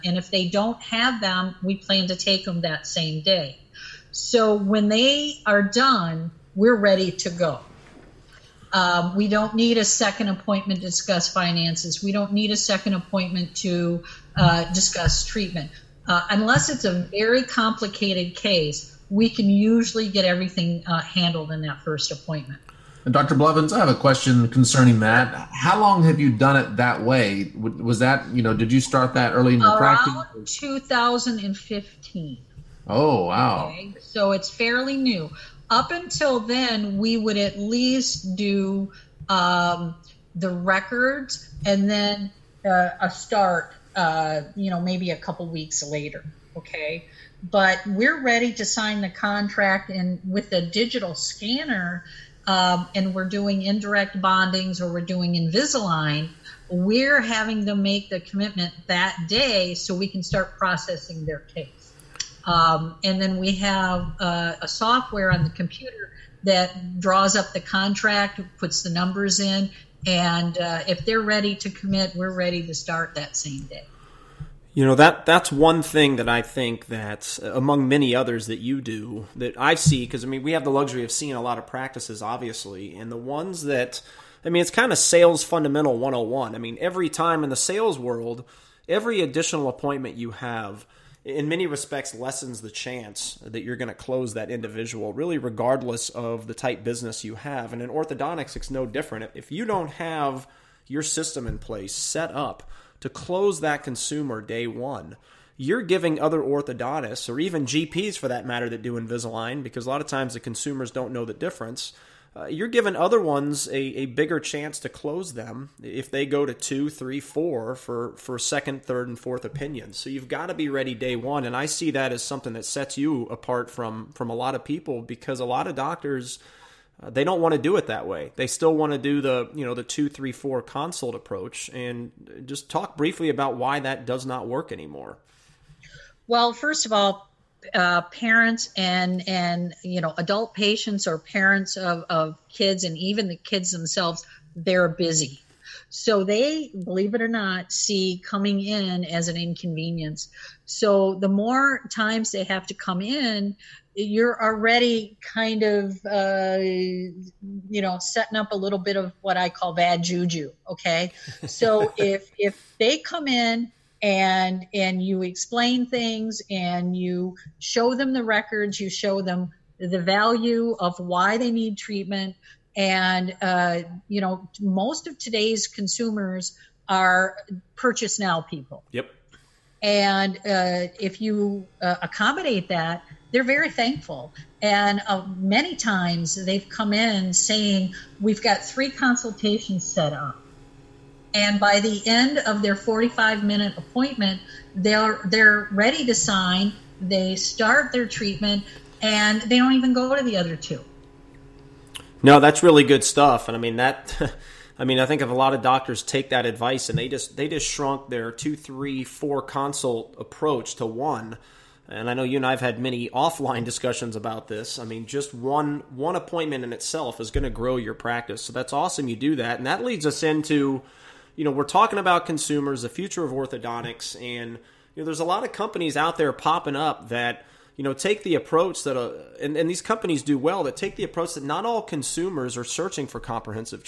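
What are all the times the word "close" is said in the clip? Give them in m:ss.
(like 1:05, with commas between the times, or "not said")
1:33, 1:43, 1:54.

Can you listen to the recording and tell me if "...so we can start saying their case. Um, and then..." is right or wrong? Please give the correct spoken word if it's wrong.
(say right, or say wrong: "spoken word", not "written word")
wrong: "processing", not "saying".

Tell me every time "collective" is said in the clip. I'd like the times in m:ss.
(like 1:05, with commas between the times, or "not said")
not said.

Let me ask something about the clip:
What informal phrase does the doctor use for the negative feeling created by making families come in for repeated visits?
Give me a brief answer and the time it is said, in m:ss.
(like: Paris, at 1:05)
bad juju, at 2:39.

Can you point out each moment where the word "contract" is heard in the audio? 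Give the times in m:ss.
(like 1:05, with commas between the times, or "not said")
0:49, 1:07.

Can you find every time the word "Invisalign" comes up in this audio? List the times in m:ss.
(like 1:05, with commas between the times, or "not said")
0:55, 1:48.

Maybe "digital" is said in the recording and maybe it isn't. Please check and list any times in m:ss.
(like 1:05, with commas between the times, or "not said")
0:50.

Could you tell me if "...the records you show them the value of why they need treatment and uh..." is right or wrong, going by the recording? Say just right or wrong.
right.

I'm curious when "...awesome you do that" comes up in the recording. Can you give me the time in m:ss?
3:38.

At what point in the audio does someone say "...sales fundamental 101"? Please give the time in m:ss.
1:24.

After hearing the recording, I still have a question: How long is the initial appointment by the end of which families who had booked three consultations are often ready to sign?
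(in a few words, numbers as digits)
45 minutes.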